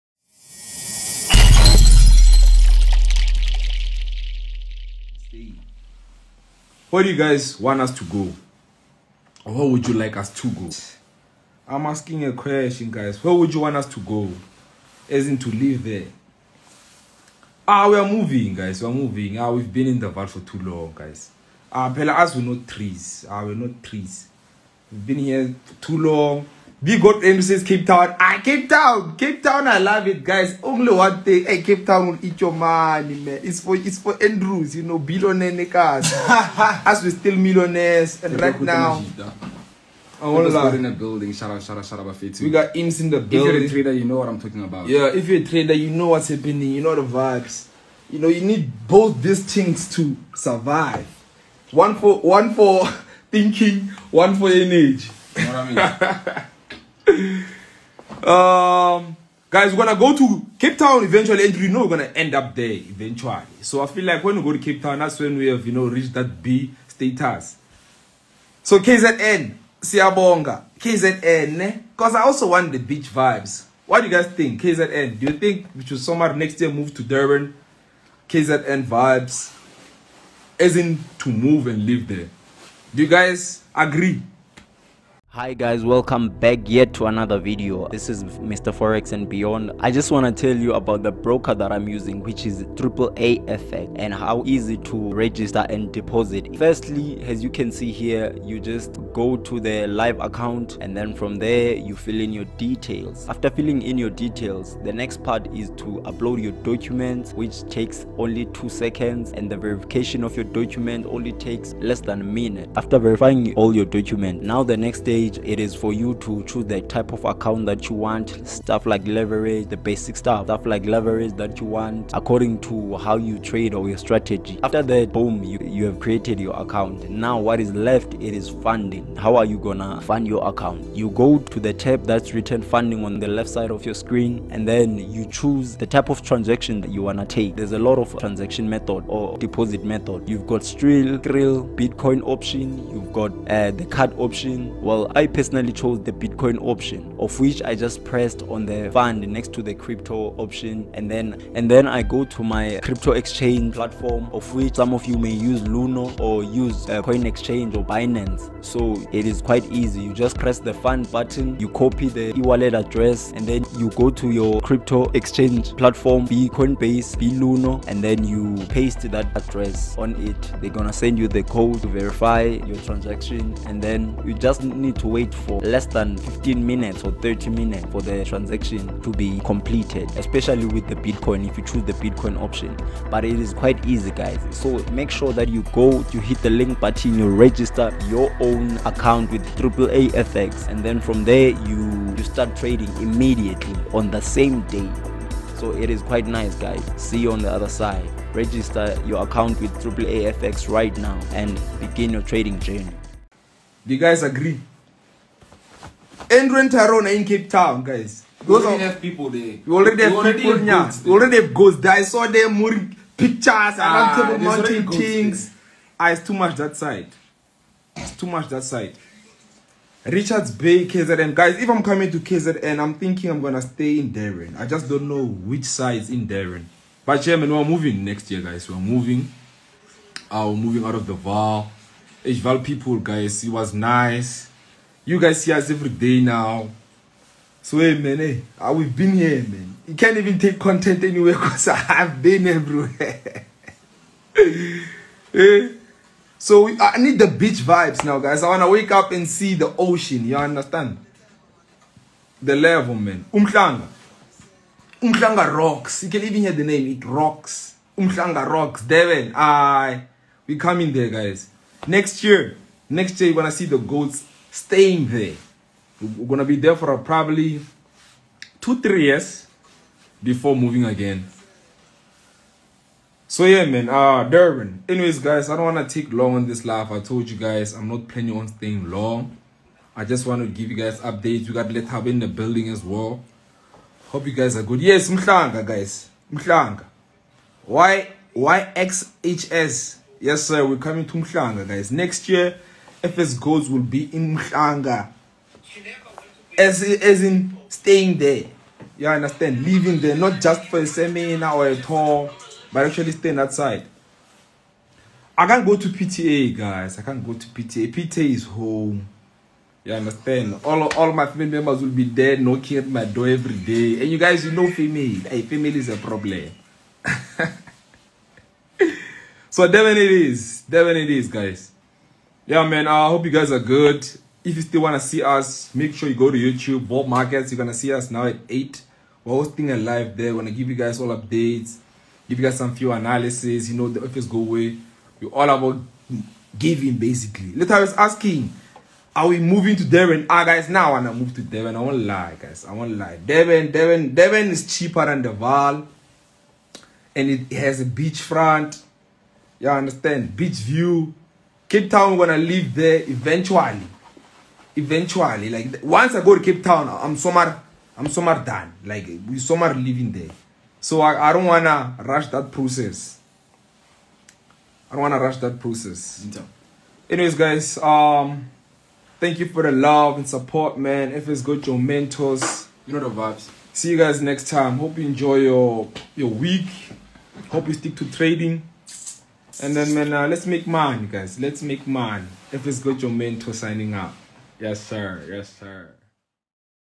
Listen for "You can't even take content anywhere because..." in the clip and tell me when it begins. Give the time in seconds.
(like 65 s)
239 s.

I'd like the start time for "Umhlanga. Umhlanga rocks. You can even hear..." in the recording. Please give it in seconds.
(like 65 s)
253 s.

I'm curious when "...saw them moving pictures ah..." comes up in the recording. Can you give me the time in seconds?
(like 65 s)
212 s.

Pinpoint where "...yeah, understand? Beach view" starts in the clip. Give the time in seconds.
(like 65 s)
349 s.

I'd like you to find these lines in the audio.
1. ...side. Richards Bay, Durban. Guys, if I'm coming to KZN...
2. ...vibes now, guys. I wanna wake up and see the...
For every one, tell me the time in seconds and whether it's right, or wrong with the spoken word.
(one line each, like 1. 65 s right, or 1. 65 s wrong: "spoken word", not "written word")
1. 218 s wrong: "KZN", not "Durban"
2. 247 s right.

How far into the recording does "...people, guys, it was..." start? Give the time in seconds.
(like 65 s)
232 s.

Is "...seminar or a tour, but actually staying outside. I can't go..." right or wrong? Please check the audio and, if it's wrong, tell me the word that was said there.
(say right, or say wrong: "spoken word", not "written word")
right.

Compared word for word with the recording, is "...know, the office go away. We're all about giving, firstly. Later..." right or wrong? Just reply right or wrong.
wrong.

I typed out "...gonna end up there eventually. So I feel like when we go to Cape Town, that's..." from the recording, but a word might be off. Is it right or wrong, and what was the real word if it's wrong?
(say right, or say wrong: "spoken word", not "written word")
right.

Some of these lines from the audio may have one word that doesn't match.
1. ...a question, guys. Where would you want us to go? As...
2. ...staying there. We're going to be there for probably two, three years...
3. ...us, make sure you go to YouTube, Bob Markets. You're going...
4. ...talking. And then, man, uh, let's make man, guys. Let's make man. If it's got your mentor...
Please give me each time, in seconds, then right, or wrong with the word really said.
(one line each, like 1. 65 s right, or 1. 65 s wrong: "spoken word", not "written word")
1. 12 s right
2. 264 s right
3. 325 s right
4. 378 s wrong: "trading", not "talking".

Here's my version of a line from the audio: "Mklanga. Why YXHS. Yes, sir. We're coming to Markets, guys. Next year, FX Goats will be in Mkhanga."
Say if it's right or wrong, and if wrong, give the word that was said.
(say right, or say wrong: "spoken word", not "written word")
wrong: "Mklanga", not "Markets".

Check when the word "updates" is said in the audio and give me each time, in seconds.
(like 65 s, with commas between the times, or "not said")
280 s, 331 s.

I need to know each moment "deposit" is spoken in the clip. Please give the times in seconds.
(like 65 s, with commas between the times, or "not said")
95 s, 139 s.